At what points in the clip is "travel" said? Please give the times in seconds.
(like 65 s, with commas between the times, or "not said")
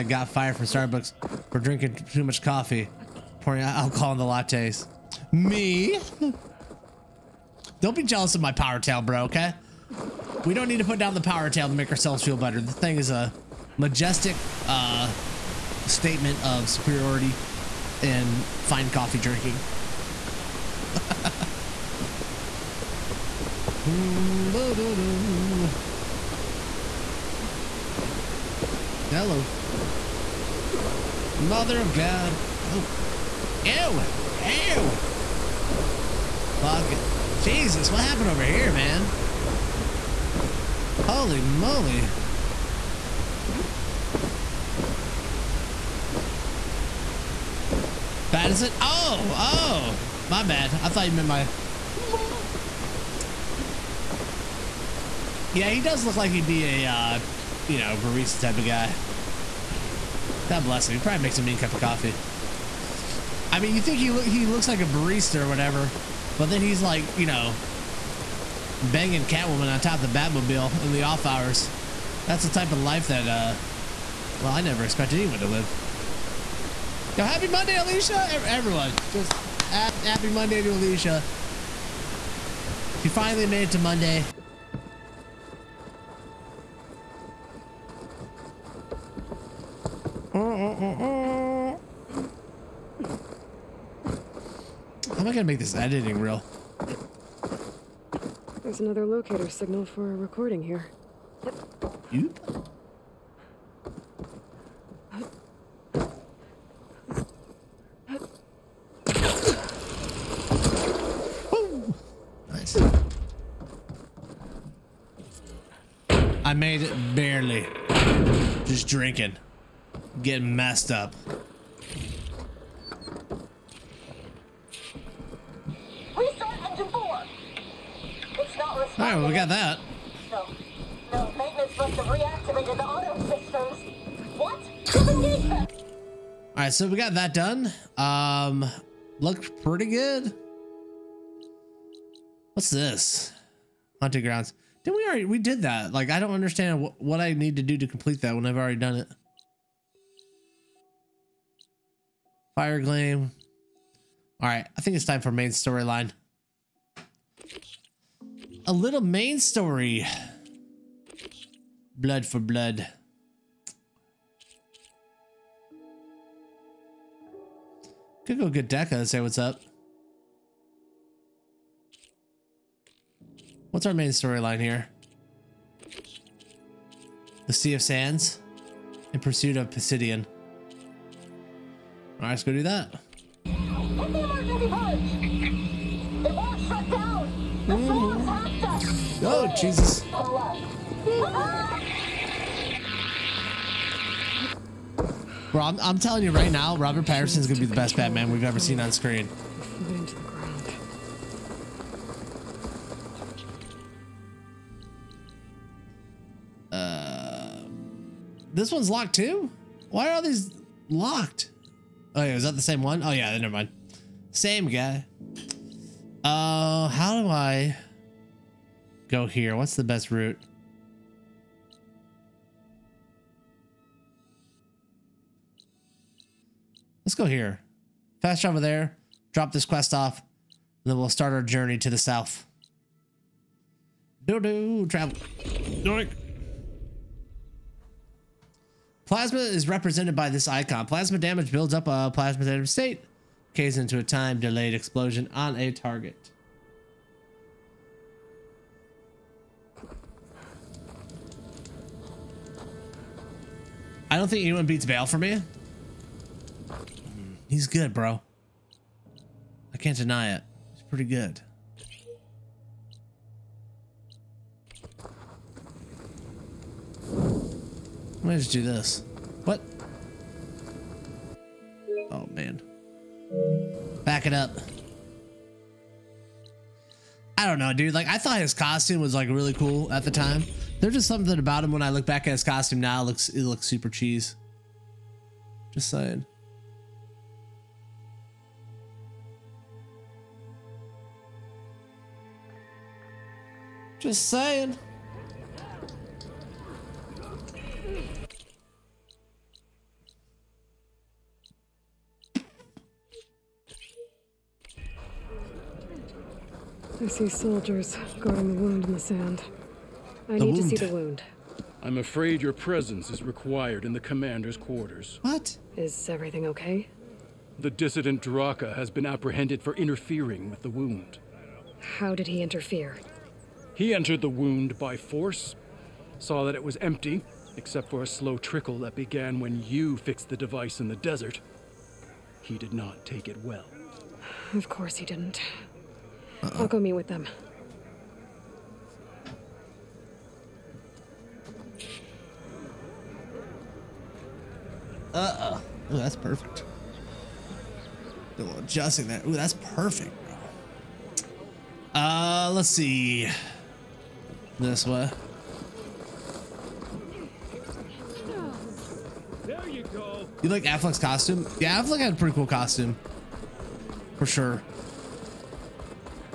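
228 s, 234 s.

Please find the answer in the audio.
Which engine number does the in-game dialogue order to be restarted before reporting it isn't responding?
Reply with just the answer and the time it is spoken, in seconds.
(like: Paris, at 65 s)
4, at 126 s.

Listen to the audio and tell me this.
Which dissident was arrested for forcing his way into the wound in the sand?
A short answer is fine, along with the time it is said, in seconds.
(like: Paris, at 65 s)
Drakka, at 318 s.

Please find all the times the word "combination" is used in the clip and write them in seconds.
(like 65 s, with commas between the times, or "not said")
not said.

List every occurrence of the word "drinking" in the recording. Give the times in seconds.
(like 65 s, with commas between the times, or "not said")
1 s, 19 s, 118 s.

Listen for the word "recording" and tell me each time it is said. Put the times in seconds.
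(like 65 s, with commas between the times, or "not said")
100 s.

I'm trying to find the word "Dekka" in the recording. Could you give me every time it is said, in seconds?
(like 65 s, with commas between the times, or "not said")
168 s.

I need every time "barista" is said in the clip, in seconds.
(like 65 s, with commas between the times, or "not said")
57 s, 64 s.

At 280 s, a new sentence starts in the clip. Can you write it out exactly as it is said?
There's just something about him when I look back at his costume now.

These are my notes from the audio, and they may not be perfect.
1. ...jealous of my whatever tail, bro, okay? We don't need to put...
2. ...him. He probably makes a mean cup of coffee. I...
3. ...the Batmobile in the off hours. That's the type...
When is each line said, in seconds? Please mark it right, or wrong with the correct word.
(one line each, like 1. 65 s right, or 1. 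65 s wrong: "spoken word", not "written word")
1. 8 s wrong: "power", not "whatever"
2. 60 s right
3. 70 s right.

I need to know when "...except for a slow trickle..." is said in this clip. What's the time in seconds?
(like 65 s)
327 s.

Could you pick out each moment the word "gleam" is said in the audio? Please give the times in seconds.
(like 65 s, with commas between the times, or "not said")
152 s.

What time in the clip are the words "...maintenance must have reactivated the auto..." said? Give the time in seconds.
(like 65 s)
131 s.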